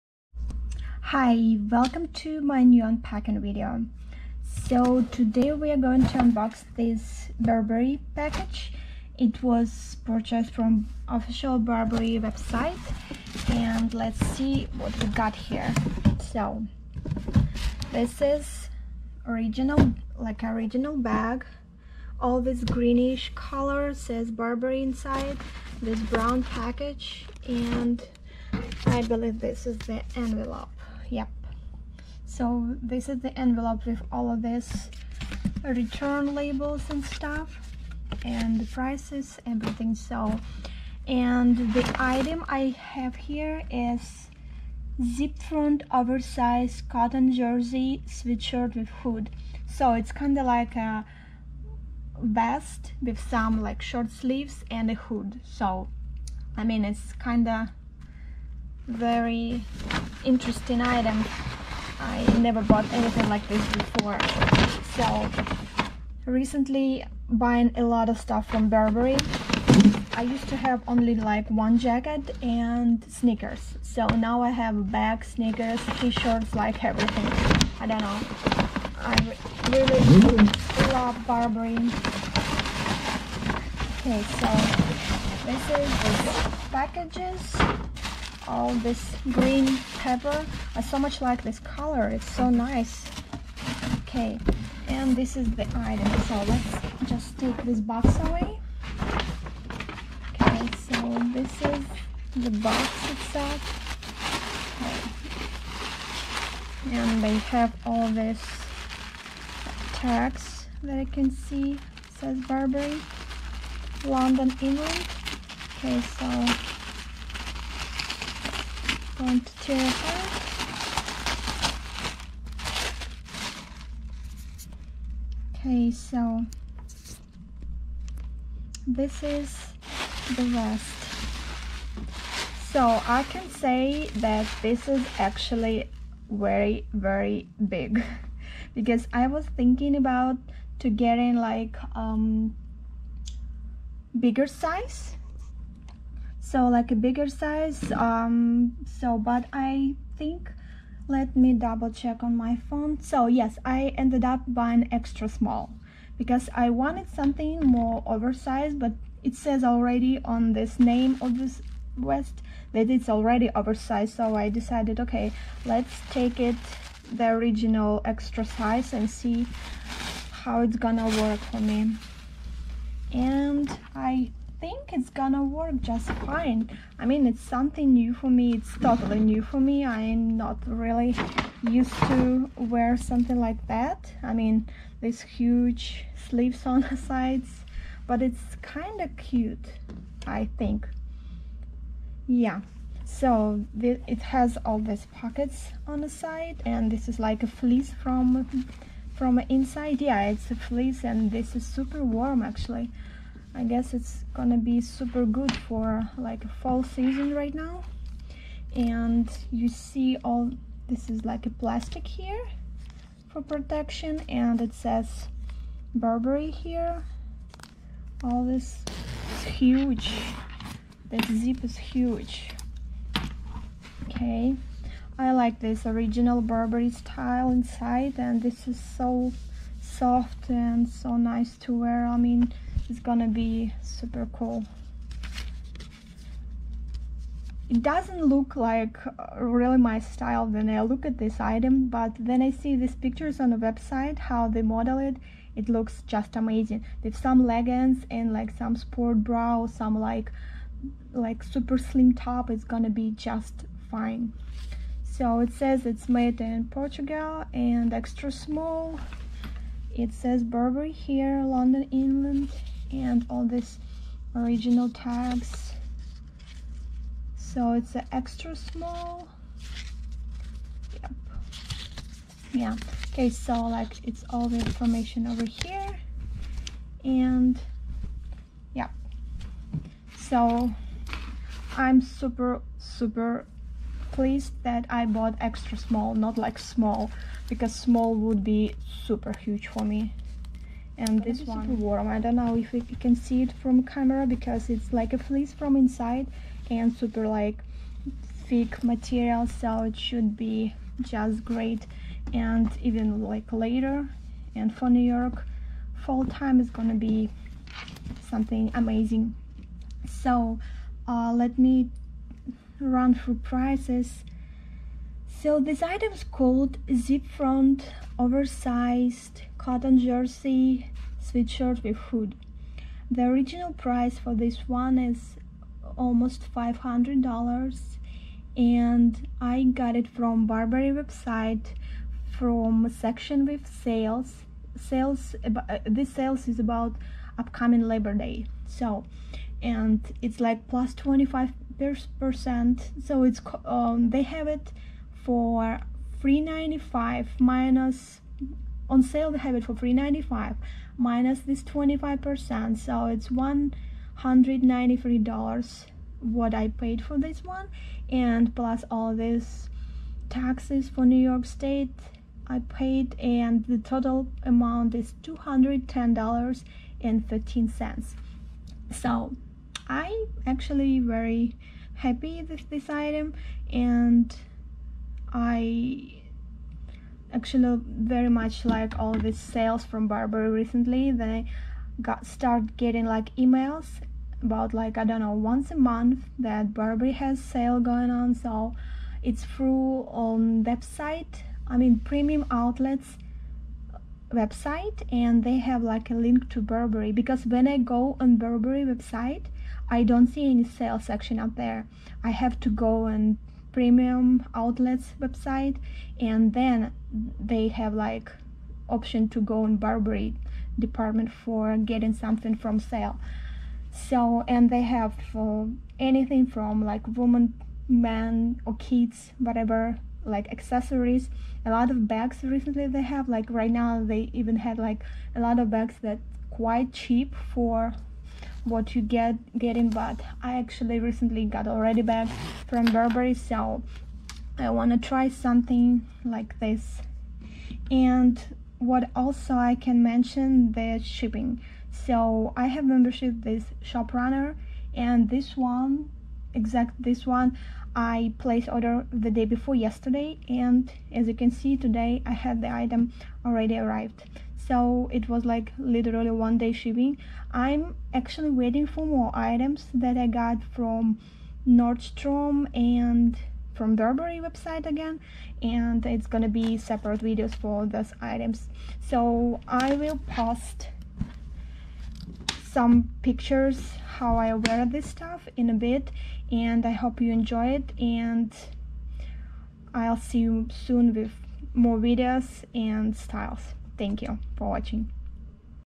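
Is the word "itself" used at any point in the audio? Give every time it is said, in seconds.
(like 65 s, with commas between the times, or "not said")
103 s.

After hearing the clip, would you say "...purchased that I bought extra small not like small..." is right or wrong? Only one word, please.
wrong.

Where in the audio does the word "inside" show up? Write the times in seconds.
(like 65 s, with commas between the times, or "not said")
24 s, 199 s, 227 s, 295 s.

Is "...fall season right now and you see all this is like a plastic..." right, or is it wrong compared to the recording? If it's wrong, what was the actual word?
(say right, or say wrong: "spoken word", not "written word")
right.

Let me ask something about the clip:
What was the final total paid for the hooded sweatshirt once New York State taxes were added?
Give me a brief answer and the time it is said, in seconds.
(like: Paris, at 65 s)
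$210.13, at 365 s.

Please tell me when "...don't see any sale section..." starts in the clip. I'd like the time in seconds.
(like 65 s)
400 s.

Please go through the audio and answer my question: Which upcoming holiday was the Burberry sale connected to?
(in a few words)
Labor Day.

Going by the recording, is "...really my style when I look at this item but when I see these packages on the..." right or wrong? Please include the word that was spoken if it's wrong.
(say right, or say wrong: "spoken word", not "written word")
wrong: "pictures", not "packages".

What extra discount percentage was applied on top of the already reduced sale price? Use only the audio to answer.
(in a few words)
25%.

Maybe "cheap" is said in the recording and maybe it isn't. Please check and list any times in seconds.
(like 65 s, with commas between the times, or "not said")
426 s.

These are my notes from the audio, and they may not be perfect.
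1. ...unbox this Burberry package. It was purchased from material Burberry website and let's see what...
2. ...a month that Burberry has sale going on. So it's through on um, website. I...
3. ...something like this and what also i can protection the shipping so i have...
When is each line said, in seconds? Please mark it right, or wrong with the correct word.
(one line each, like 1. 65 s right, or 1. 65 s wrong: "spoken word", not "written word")
1. 6 s wrong: "official", not "material"
2. 385 s right
3. 435 s wrong: "mention", not "protection".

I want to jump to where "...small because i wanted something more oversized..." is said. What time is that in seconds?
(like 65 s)
155 s.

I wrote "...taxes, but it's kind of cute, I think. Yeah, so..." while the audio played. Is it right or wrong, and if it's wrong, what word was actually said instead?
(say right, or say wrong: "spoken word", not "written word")
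wrong: "sides", not "taxes".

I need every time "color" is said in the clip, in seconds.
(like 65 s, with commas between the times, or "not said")
23 s, 91 s.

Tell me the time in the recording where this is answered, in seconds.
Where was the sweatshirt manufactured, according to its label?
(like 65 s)
256 s.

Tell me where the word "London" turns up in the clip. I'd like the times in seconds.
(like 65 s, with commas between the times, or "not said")
114 s, 261 s.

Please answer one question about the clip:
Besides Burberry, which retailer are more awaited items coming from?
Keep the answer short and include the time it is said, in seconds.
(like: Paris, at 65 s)
Nordstrom, at 461 s.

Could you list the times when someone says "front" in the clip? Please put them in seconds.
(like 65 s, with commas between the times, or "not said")
45 s, 317 s.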